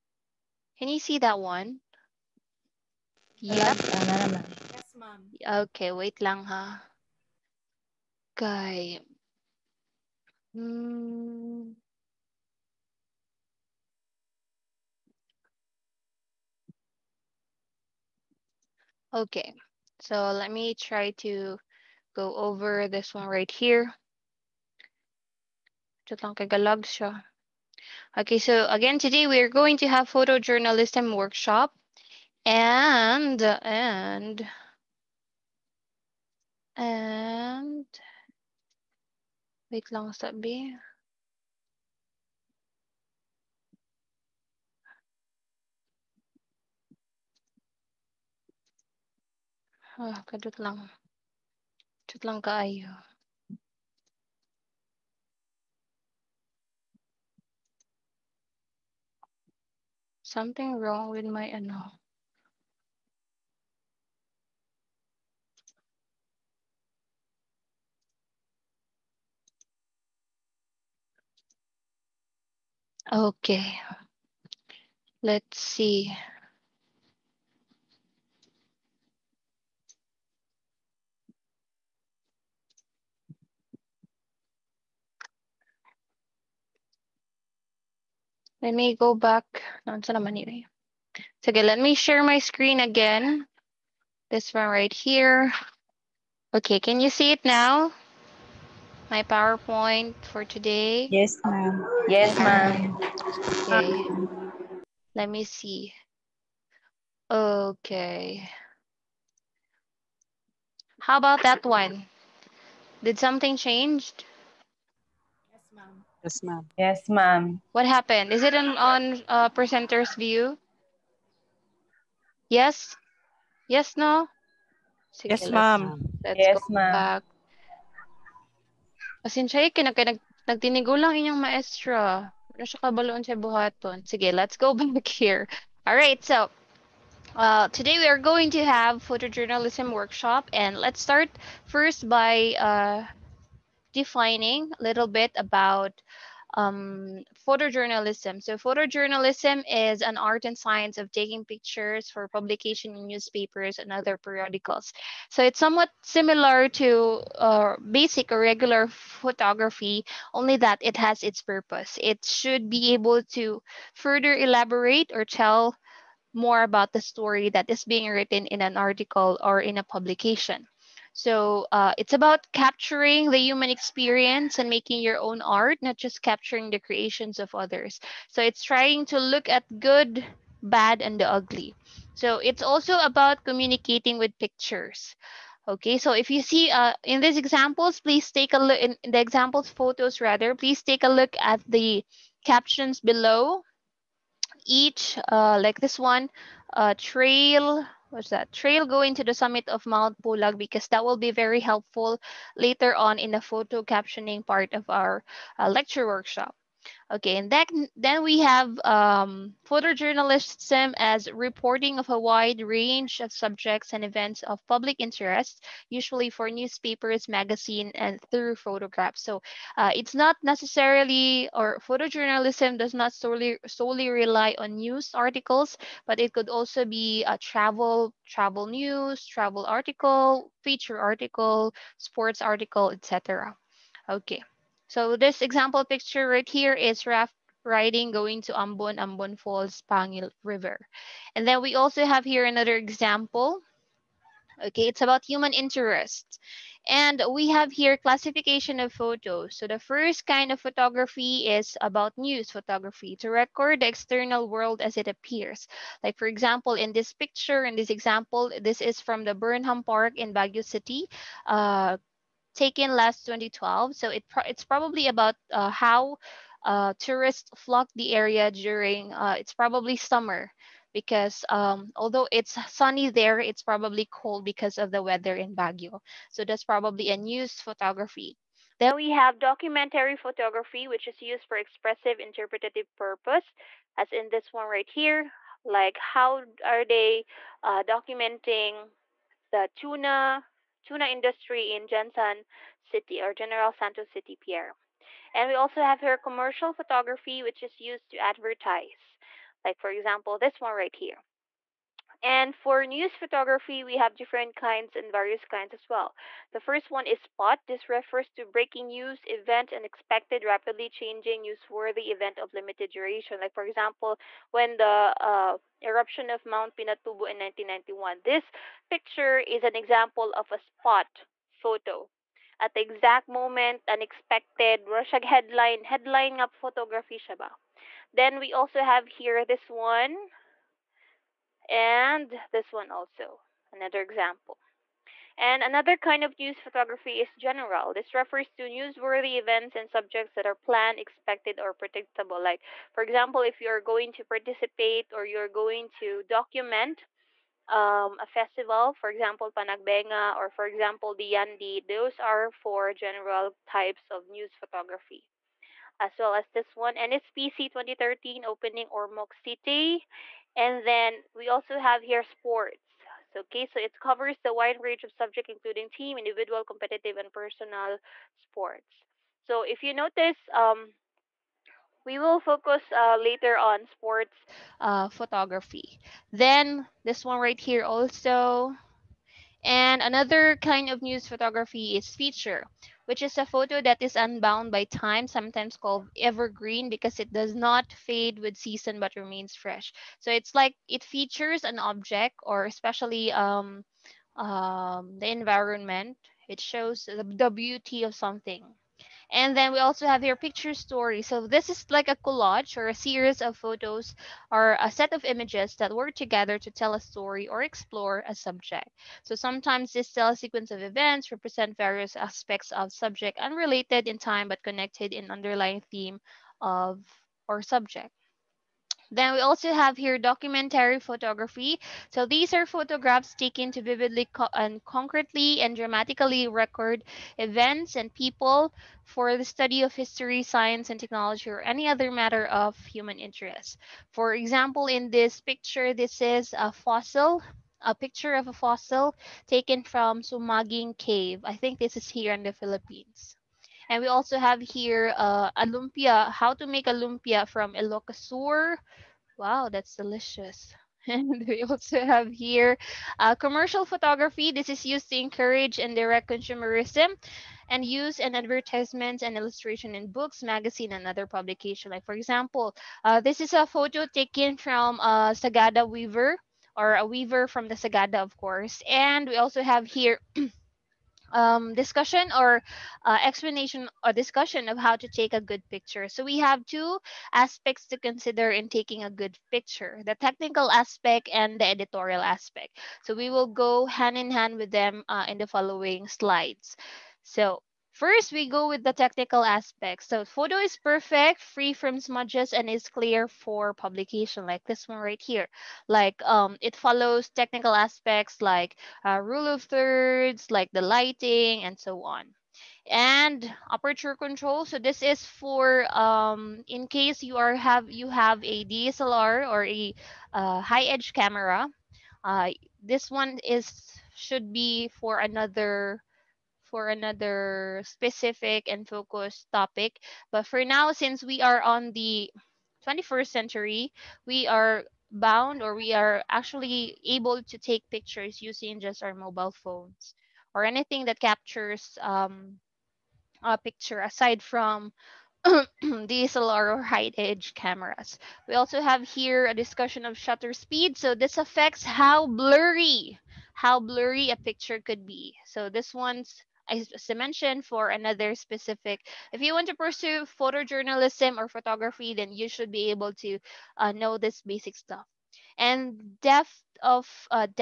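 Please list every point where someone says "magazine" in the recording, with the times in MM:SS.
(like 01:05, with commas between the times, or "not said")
03:37, 07:40.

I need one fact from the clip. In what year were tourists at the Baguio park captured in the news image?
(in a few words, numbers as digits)
2012.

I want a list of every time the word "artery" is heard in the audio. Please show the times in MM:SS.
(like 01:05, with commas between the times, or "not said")
not said.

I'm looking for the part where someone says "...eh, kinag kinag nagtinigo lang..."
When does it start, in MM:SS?
02:09.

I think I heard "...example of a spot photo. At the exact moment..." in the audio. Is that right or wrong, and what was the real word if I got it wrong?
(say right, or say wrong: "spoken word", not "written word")
right.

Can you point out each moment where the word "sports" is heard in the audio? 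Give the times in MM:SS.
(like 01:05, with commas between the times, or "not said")
03:51, 06:02, 06:08, 06:13.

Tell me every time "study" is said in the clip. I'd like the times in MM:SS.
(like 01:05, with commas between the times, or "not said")
07:09.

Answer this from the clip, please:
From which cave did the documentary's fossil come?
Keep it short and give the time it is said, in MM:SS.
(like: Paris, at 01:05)
Sumaging Cave, at 07:20.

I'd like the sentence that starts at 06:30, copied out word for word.
So it's like it features an object or especially um, um, the environment.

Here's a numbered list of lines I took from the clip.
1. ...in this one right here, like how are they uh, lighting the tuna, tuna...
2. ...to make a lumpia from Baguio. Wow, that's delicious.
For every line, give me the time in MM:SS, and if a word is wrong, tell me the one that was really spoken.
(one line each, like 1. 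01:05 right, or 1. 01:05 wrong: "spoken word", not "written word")
1. 04:44 wrong: "documenting", not "lighting"
2. 07:26 wrong: "Ilocosur", not "Baguio".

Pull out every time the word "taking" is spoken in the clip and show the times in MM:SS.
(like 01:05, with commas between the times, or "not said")
02:31, 07:58.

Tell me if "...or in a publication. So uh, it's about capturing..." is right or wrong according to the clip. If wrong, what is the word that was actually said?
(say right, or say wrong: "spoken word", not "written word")
right.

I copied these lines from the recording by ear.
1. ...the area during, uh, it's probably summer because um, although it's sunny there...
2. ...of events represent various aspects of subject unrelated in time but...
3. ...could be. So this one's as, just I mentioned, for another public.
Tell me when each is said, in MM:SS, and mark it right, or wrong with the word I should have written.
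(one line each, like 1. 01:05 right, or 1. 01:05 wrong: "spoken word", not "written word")
1. 04:27 right
2. 06:50 right
3. 09:04 wrong: "specific", not "public".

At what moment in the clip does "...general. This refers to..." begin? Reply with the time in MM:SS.
05:37.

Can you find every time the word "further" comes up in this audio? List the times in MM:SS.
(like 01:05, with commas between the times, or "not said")
02:43.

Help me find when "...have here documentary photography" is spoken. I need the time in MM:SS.
06:59.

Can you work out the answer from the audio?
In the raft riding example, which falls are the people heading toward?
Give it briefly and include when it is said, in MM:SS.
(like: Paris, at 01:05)
Ambon Falls, at 03:58.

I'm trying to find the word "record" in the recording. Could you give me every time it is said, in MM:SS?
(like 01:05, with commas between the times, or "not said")
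04:13, 07:06.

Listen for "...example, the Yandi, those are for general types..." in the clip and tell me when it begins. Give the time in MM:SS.
05:50.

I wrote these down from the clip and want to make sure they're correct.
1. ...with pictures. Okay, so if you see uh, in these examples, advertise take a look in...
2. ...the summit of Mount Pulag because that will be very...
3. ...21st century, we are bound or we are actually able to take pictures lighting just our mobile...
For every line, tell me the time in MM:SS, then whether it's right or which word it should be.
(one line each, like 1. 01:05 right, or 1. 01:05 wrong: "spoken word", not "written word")
1. 03:04 wrong: "please", not "advertise"
2. 03:19 right
3. 08:42 wrong: "using", not "lighting".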